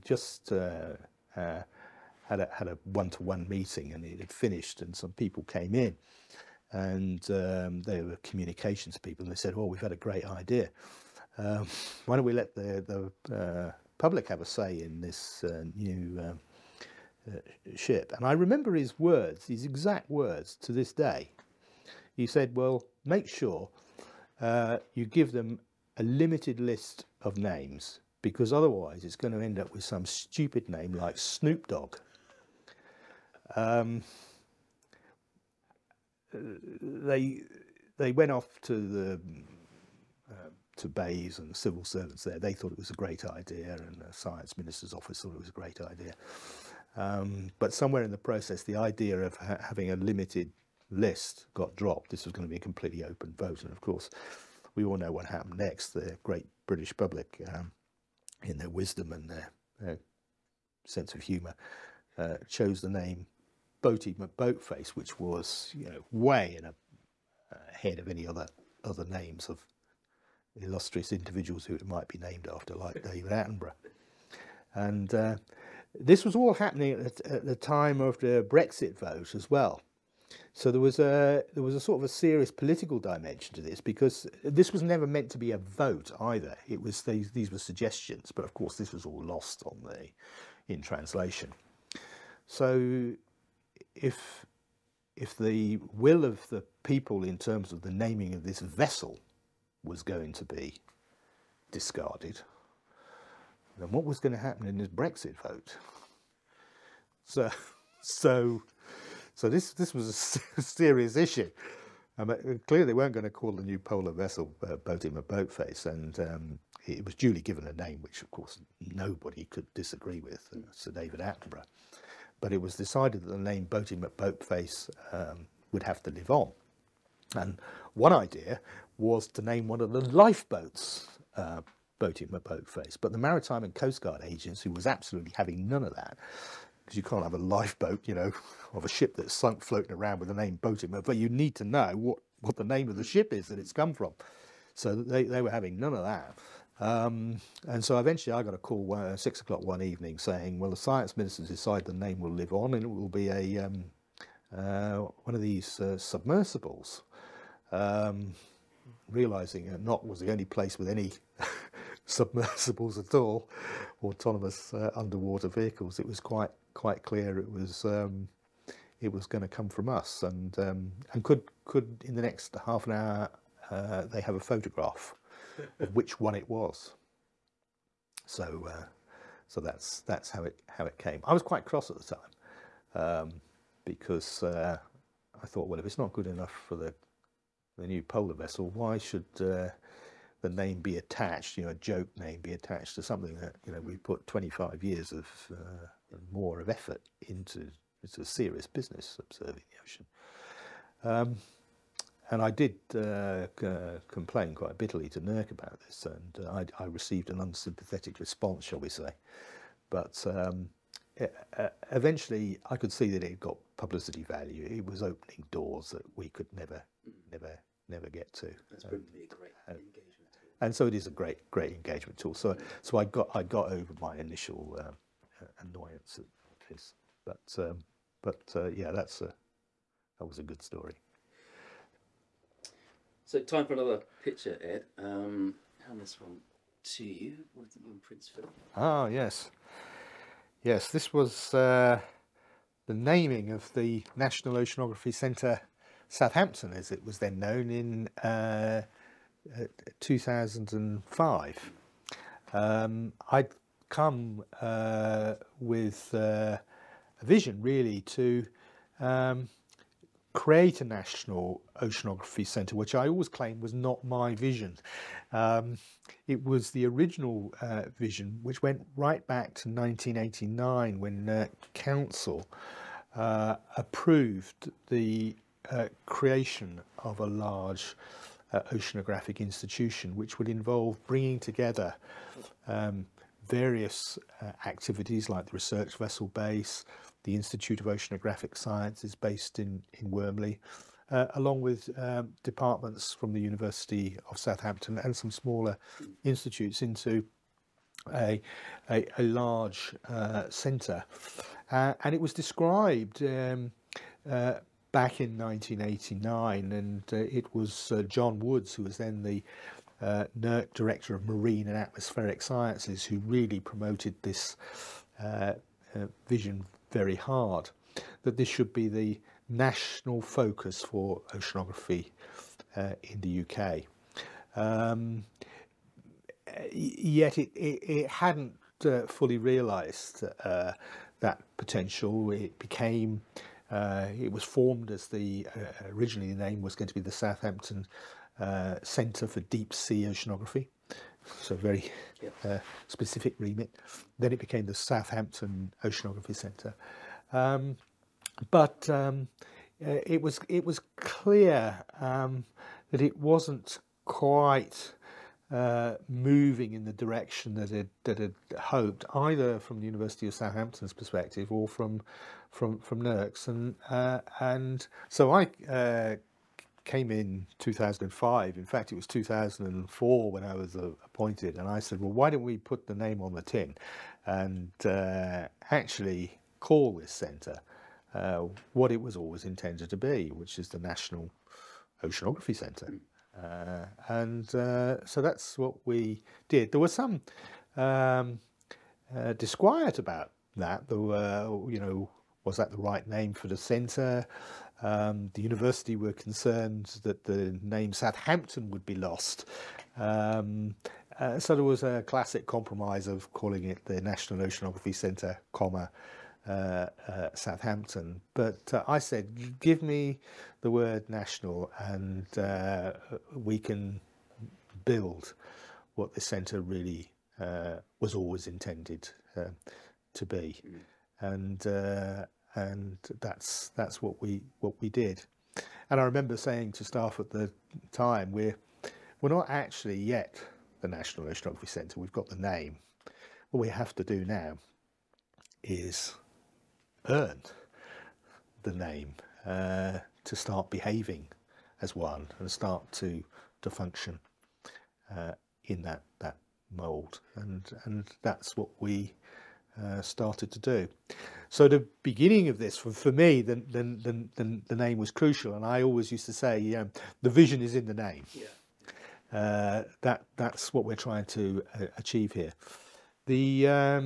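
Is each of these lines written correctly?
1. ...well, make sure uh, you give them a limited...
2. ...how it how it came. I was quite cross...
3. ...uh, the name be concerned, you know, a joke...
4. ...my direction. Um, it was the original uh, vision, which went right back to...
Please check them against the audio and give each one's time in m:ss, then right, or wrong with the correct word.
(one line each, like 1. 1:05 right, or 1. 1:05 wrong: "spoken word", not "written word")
1. 0:22 right
2. 3:00 right
3. 3:09 wrong: "attached", not "concerned"
4. 4:24 wrong: "vision", not "direction".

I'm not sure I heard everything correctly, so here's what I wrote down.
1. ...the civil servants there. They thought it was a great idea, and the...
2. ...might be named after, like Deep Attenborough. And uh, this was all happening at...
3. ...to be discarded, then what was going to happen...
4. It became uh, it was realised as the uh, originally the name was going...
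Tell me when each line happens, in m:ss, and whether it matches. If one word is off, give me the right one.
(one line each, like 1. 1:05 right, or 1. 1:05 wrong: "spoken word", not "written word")
1. 0:41 right
2. 1:11 wrong: "David", not "Deep"
3. 1:40 right
4. 5:32 wrong: "formed", not "realised".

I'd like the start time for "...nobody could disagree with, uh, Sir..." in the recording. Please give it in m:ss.
1:58.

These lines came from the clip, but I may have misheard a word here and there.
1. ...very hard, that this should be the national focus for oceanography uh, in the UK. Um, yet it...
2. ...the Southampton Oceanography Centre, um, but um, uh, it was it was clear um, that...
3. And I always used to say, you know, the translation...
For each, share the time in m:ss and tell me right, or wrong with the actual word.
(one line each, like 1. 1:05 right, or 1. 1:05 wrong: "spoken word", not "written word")
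1. 5:16 right
2. 5:44 right
3. 7:35 wrong: "vision", not "translation".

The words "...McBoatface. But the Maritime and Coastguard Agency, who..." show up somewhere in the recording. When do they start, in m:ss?
2:12.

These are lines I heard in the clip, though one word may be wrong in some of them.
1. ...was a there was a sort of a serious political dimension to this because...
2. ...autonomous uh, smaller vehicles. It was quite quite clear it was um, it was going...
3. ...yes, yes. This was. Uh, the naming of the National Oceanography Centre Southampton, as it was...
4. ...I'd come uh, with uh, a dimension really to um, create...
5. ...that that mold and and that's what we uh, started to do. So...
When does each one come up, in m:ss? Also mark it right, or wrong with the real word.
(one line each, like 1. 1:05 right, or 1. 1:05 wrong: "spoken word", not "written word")
1. 1:20 right
2. 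2:44 wrong: "underwater", not "smaller"
3. 3:59 right
4. 4:13 wrong: "vision", not "dimension"
5. 7:25 right.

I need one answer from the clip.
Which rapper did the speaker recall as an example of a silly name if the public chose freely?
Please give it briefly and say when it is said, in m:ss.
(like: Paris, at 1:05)
Snoop Dogg, at 0:31.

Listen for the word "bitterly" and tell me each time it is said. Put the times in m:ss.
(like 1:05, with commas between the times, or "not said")
3:24.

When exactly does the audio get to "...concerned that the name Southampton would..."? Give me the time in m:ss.
6:36.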